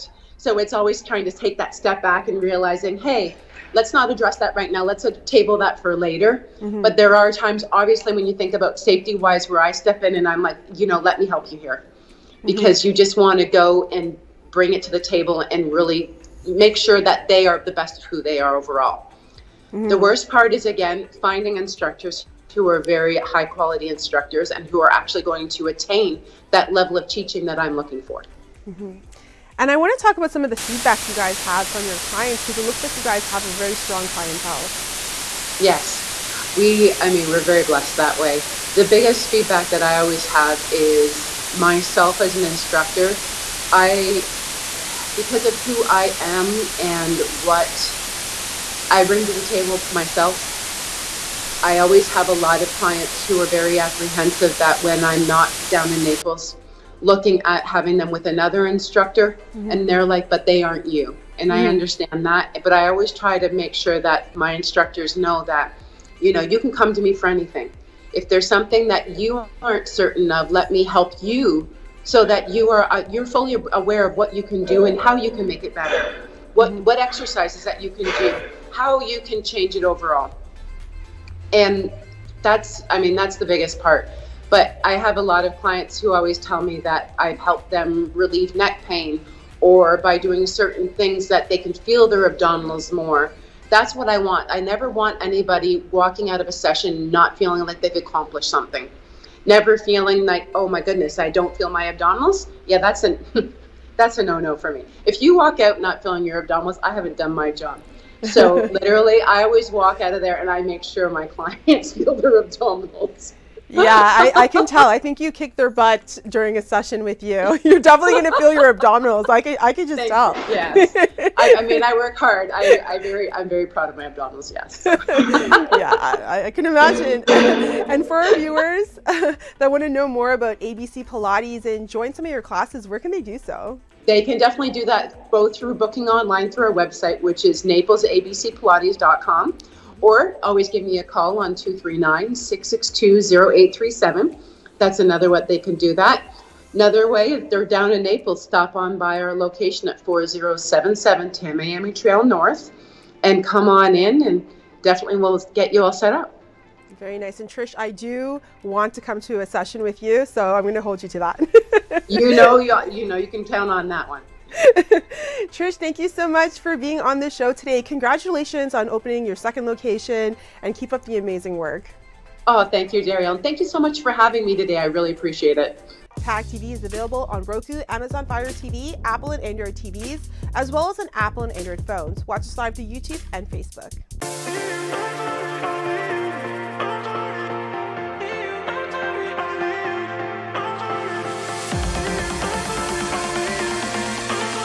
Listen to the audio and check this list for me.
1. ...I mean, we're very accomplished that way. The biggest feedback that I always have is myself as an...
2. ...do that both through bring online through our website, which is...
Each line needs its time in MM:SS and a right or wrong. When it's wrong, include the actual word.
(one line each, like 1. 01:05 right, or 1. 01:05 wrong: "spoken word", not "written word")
1. 00:37 wrong: "blessed", not "accomplished"
2. 02:14 wrong: "booking", not "bring".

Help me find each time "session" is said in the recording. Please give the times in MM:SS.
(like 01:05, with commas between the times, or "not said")
01:36, 01:56, 02:39.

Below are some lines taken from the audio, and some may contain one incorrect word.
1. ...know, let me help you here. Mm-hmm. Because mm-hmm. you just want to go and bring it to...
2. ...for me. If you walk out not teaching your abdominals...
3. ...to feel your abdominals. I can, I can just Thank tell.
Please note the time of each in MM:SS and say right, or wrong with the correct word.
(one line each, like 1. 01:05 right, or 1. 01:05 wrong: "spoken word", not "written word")
1. 00:10 right
2. 01:44 wrong: "feeling", not "teaching"
3. 01:58 right.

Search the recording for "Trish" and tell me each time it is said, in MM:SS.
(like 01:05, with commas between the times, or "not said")
02:37, 02:45.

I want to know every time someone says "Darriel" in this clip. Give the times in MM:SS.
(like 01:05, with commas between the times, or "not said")
02:53.